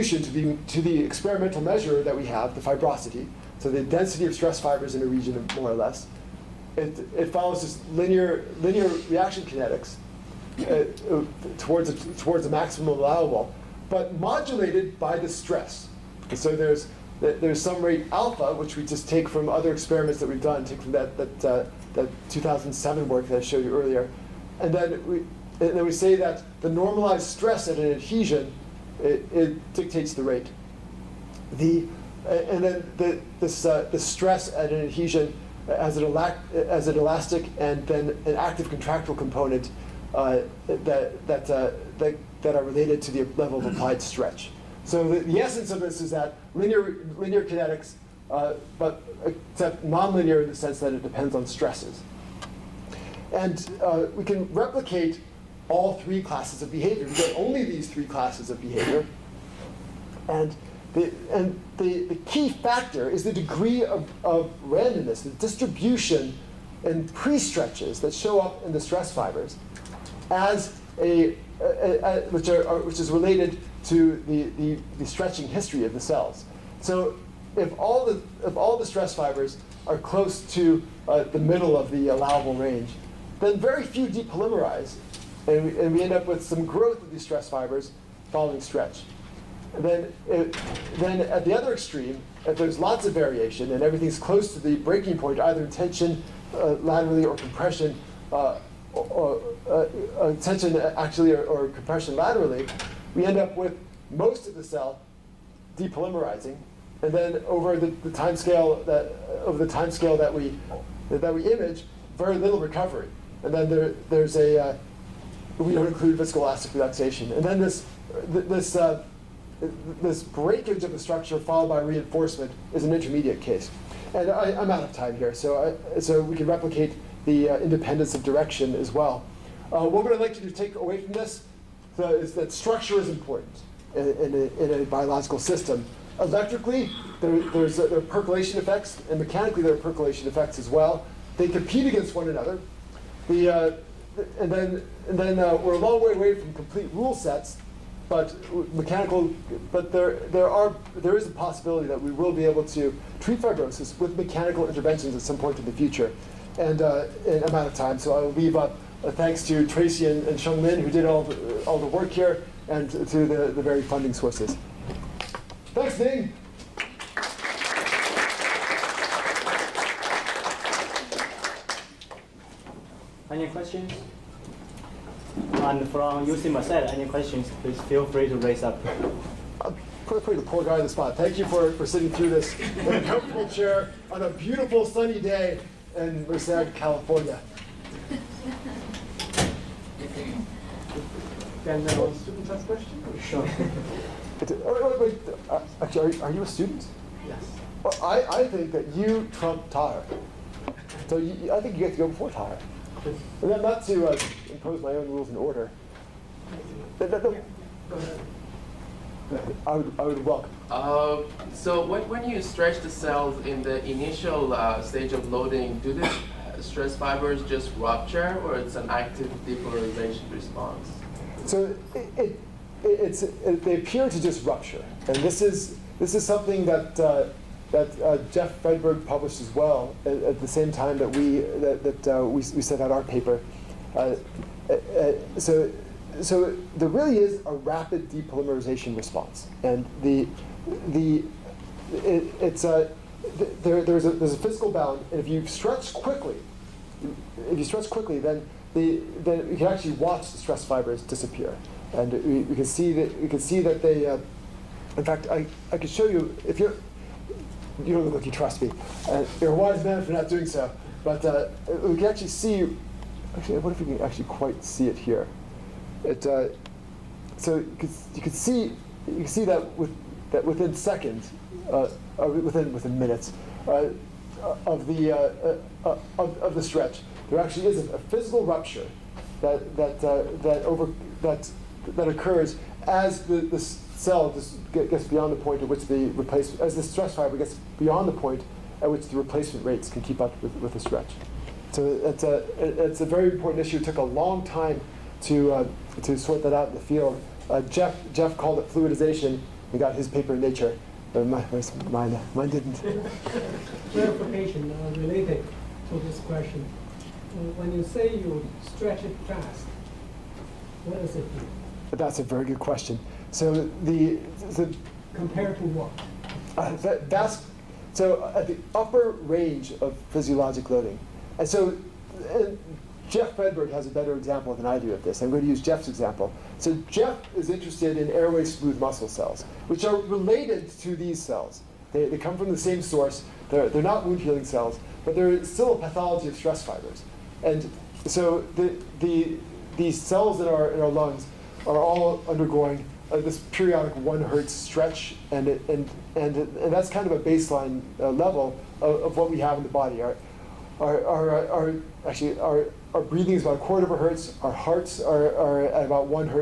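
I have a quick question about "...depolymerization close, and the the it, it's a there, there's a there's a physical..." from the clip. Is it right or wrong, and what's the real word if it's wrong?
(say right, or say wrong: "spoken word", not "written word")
wrong: "response", not "close".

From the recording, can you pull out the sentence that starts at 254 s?
Uh, in fact, I, I could show you if you're you don't look like you trust me.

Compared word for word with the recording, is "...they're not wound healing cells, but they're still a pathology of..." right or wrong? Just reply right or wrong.
right.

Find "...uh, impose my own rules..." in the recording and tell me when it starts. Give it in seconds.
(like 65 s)
204 s.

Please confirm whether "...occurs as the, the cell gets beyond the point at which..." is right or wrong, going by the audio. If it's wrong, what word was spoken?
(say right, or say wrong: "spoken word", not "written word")
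right.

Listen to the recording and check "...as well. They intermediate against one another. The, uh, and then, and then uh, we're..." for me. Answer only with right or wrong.
wrong.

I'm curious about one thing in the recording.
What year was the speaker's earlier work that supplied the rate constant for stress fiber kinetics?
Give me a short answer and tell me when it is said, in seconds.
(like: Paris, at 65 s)
2007, at 22 s.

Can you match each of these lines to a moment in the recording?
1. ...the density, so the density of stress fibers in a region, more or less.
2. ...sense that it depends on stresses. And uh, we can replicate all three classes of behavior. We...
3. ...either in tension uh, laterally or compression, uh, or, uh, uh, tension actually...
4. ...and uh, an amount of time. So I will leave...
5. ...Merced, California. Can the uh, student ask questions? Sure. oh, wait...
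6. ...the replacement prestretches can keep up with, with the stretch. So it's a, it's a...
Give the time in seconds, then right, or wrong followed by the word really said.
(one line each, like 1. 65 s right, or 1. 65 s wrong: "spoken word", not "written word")
1. 2 s wrong: "fibrosity", not "density"
2. 50 s right
3. 95 s right
4. 156 s right
5. 186 s right
6. 289 s wrong: "rates", not "prestretches".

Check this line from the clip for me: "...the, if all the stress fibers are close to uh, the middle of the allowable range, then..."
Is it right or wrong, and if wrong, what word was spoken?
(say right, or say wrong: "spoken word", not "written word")
right.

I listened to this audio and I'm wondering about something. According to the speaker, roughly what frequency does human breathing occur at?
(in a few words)
a quarter of a hertz.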